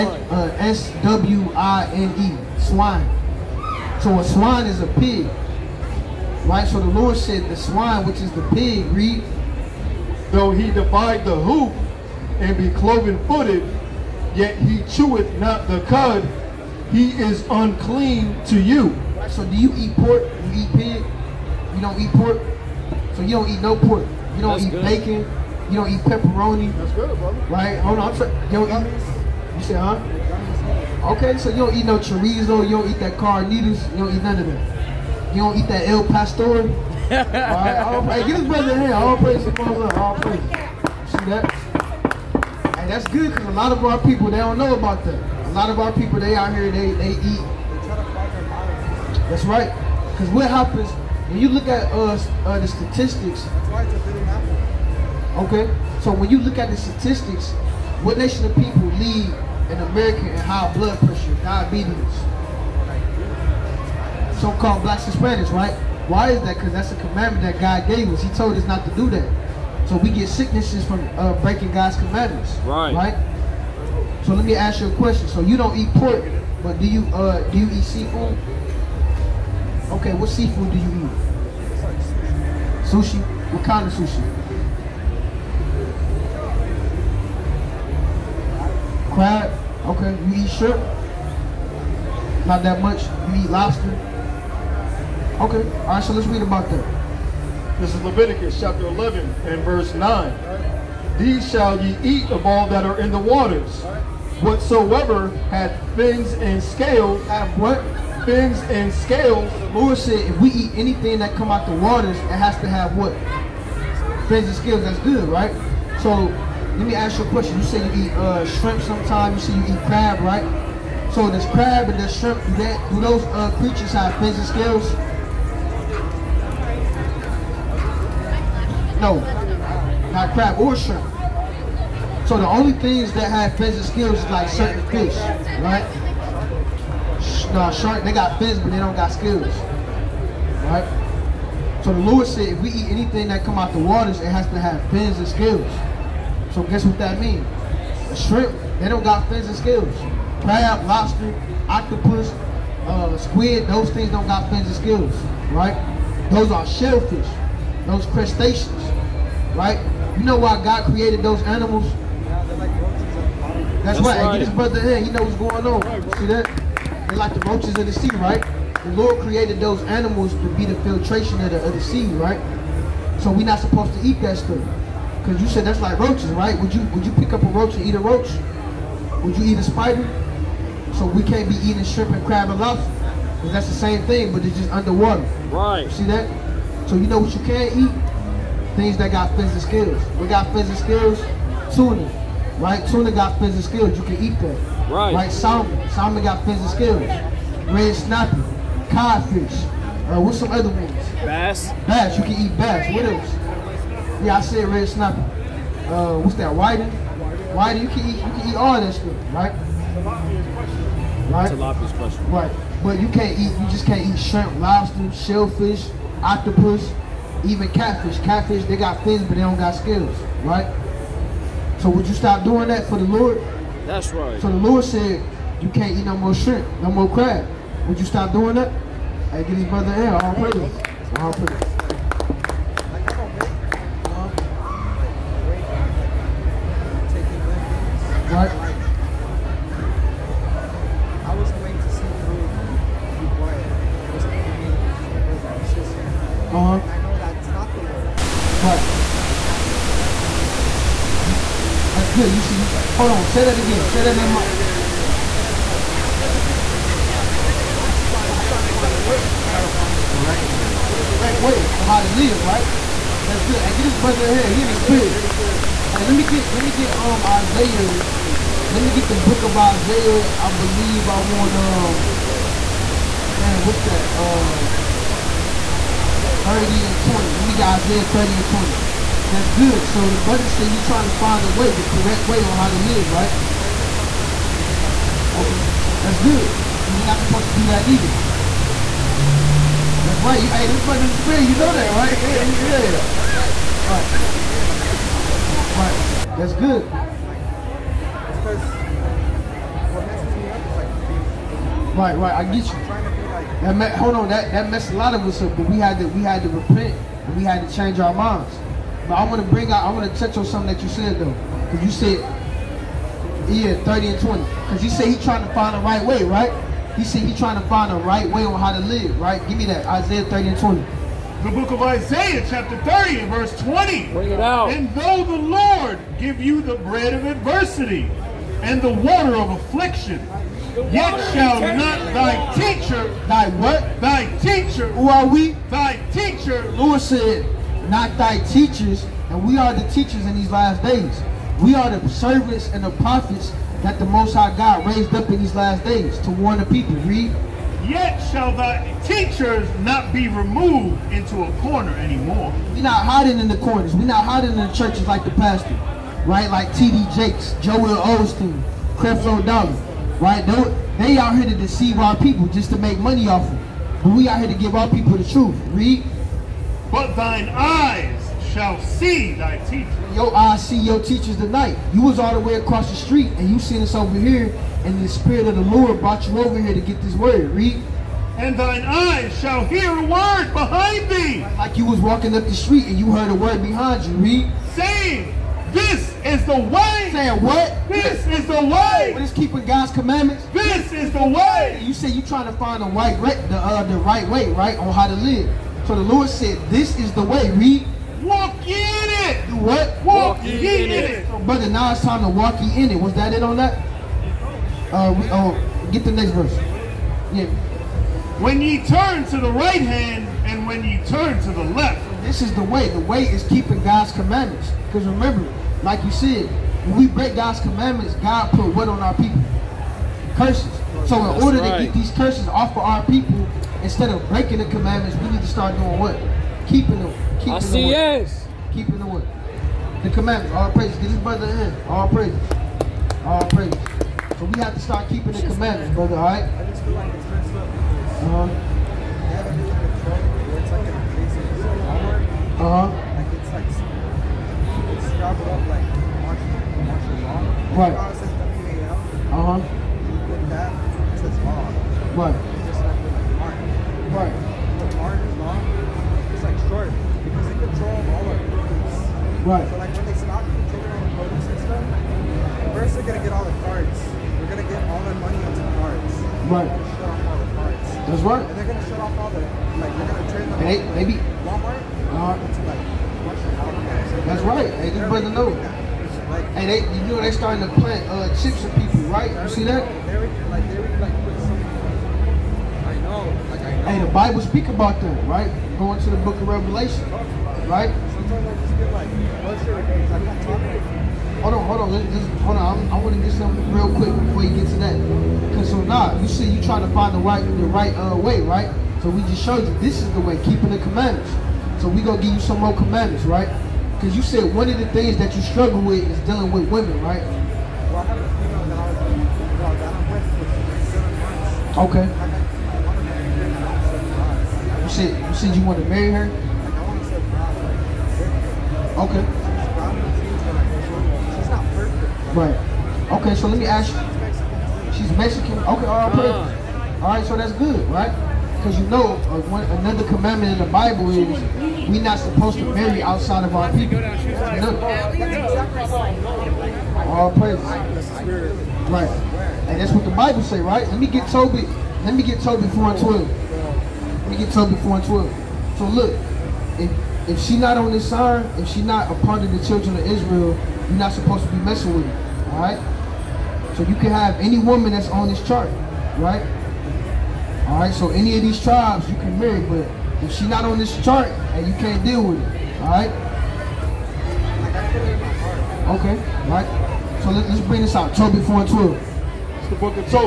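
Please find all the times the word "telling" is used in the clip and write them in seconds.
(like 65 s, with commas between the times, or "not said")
not said.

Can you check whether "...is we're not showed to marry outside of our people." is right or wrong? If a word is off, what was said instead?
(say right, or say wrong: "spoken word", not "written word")
wrong: "supposed", not "showed".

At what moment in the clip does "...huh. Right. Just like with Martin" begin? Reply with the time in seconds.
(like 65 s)
449 s.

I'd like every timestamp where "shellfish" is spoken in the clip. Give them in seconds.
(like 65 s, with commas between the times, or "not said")
156 s, 215 s.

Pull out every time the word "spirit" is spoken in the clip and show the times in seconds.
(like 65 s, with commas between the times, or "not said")
264 s, 291 s, 375 s.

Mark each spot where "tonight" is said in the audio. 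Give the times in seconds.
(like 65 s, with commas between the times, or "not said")
371 s.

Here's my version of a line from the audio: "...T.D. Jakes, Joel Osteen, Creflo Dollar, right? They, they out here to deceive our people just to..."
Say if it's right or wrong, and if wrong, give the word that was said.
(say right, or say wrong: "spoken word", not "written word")
right.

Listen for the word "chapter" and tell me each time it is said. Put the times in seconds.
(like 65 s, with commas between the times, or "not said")
98 s, 322 s.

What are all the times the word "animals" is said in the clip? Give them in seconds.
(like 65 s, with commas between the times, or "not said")
161 s, 169 s.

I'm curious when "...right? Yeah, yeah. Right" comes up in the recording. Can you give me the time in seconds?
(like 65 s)
291 s.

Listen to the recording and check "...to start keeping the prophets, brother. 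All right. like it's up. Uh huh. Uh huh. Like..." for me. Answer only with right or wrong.
wrong.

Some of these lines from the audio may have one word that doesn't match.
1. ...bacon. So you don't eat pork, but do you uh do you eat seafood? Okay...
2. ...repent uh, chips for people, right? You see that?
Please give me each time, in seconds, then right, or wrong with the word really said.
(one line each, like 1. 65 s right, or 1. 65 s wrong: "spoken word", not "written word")
1. 74 s wrong: "question", not "bacon"
2. 477 s wrong: "plant", not "repent".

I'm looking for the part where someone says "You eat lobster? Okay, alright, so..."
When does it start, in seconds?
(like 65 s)
93 s.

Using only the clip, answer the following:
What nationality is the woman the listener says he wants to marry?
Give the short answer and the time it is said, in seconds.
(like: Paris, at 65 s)
Mexican, at 524 s.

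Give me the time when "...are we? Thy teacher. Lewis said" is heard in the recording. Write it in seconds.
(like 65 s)
335 s.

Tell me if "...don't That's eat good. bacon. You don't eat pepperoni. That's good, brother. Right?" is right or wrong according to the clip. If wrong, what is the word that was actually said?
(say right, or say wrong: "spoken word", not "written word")
right.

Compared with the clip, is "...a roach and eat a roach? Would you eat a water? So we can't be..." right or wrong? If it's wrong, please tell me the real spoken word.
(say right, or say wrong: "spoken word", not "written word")
wrong: "spider", not "water".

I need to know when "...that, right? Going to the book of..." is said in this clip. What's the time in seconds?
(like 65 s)
485 s.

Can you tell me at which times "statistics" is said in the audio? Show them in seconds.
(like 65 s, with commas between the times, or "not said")
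52 s, 56 s.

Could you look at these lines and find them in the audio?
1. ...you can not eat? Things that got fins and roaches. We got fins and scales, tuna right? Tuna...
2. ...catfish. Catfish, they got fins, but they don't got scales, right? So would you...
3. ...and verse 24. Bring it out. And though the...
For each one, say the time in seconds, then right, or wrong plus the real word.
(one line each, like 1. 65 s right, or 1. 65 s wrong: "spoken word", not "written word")
1. 187 s wrong: "scales", not "roaches"
2. 217 s right
3. 323 s wrong: "20", not "24".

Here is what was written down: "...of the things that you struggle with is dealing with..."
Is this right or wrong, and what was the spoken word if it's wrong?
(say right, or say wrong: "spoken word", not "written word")
right.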